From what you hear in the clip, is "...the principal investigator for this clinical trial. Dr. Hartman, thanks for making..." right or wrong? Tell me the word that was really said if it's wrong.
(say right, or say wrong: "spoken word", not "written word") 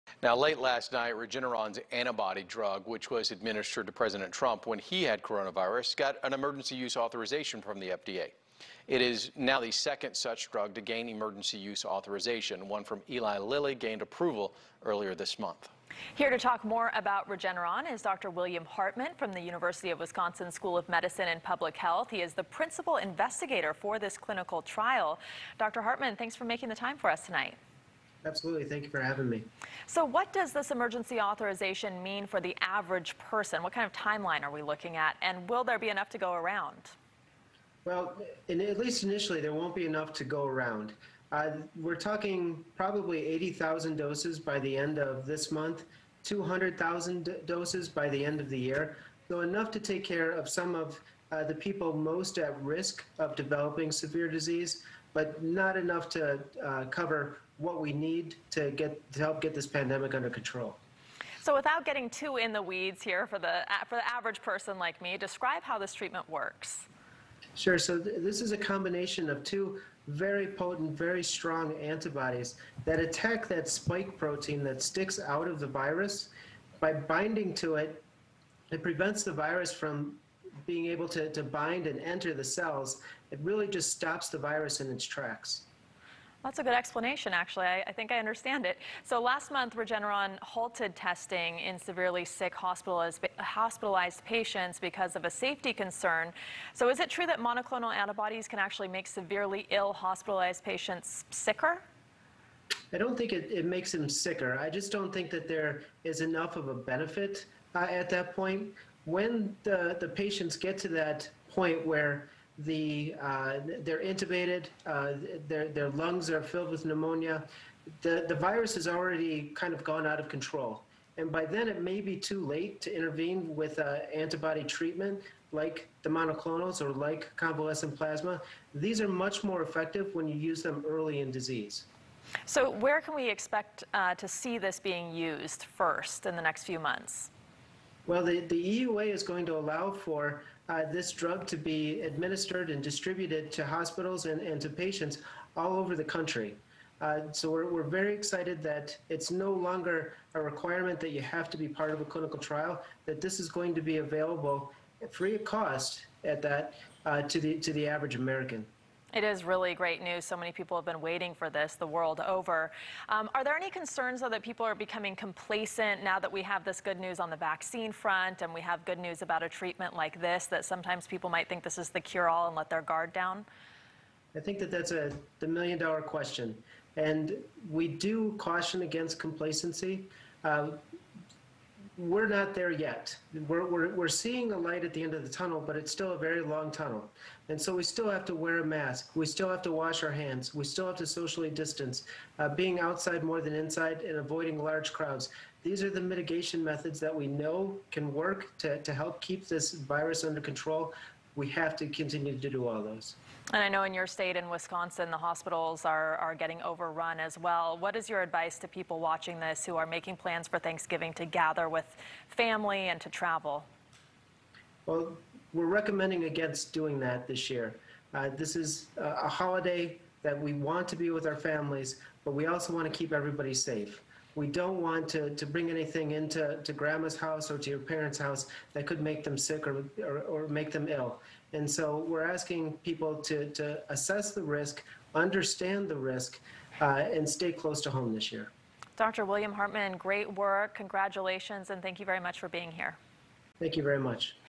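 right.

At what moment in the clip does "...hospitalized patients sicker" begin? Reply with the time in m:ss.
1:39.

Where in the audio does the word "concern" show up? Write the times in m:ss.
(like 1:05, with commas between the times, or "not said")
1:35, 2:43.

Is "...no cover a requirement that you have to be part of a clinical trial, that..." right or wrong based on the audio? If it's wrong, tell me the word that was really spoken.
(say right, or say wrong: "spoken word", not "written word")
wrong: "longer", not "cover".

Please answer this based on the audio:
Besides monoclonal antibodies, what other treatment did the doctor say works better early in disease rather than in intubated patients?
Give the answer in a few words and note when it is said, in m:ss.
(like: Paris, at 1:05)
convalescent plasma, at 2:07.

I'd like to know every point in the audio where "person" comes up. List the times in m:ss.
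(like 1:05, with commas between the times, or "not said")
0:33, 1:04.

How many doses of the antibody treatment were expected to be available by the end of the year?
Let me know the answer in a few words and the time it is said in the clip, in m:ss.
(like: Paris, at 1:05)
200,000, at 0:46.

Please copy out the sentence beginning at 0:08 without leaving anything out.
It is now the second such drug to gain emergency use authorization.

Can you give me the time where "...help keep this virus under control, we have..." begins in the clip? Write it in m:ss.
3:18.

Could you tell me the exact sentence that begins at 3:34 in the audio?
Well, we're recommending against doing that this year.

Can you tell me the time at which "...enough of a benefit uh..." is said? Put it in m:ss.
1:46.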